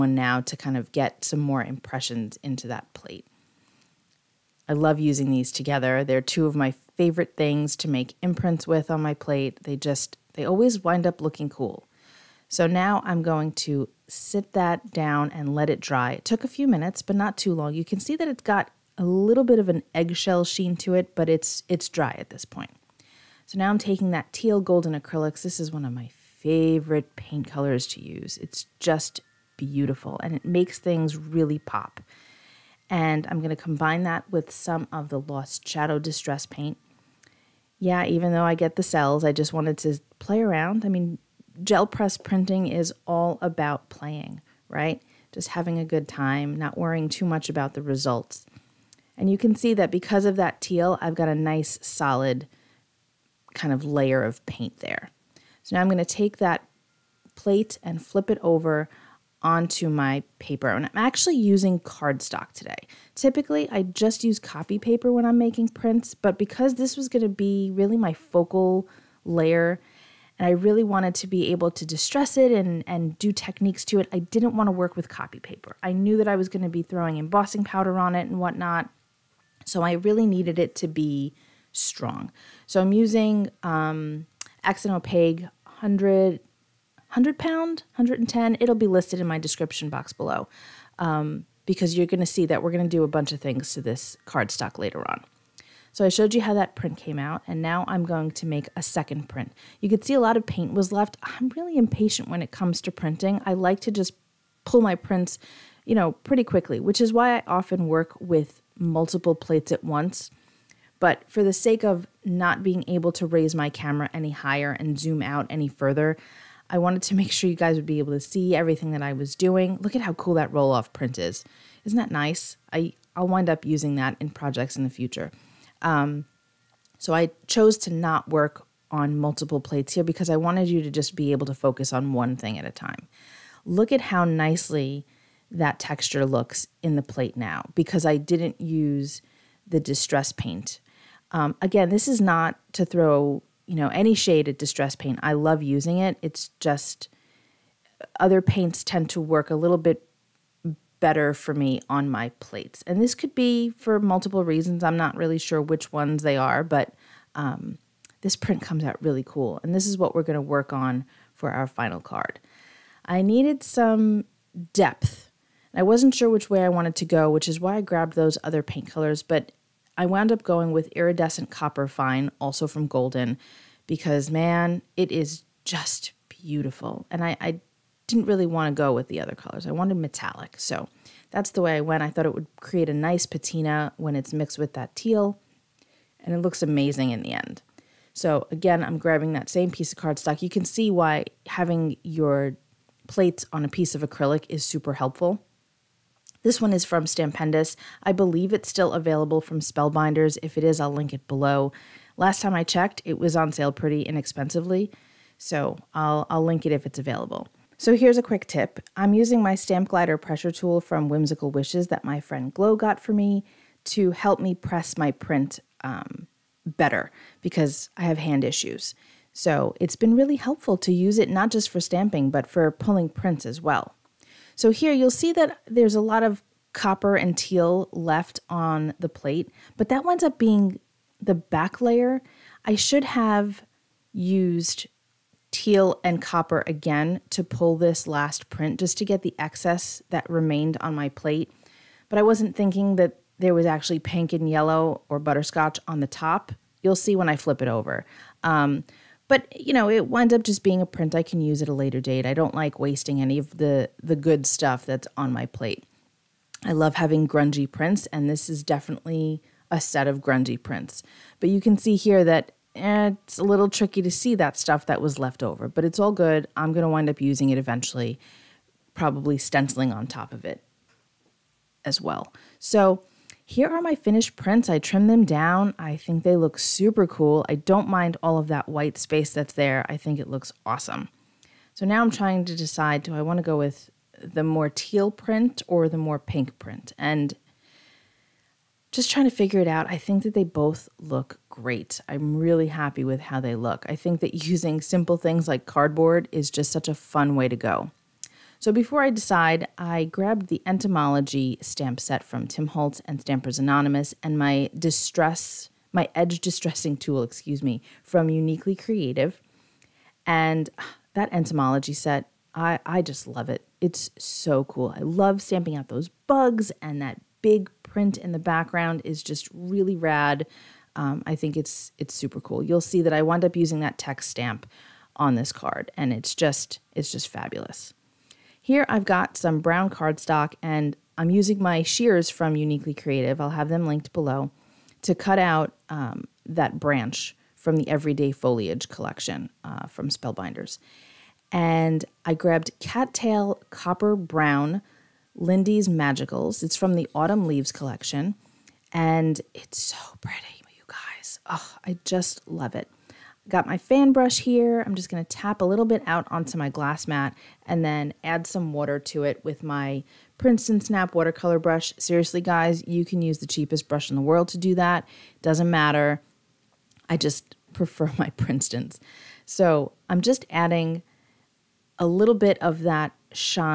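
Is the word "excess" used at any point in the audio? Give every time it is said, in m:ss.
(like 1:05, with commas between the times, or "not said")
3:59.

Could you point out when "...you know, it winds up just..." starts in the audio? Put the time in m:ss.
4:09.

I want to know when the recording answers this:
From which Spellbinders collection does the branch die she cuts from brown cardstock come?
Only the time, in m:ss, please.
5:37.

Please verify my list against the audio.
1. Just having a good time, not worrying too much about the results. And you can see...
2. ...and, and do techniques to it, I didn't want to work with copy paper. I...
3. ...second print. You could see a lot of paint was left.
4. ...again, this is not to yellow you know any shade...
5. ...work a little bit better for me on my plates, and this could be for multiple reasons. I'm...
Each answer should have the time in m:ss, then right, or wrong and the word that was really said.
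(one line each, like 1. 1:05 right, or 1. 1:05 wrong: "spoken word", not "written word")
1. 0:45 right
2. 1:12 right
3. 1:38 right
4. 2:21 wrong: "throw", not "yellow"
5. 2:29 right.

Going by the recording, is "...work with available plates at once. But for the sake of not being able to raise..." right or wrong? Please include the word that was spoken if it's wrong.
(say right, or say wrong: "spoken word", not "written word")
wrong: "multiple", not "available".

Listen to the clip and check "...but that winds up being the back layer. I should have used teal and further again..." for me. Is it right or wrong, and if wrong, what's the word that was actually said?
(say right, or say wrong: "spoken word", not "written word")
wrong: "copper", not "further".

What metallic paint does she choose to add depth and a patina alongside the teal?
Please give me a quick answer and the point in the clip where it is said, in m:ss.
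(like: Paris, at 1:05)
Iridescent Copper Fine, at 2:50.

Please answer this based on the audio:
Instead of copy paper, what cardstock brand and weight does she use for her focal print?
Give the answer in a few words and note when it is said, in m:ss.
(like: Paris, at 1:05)
Accent Opaque 100, at 1:24.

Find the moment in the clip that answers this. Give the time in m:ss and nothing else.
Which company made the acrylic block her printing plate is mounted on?
3:17.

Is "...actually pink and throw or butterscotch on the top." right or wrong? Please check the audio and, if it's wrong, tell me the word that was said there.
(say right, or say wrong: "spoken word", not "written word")
wrong: "yellow", not "throw".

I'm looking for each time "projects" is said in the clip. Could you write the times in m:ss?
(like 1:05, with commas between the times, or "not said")
2:04.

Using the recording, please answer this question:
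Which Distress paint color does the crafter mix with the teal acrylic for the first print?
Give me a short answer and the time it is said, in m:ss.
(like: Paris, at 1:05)
Lost Shadow, at 0:35.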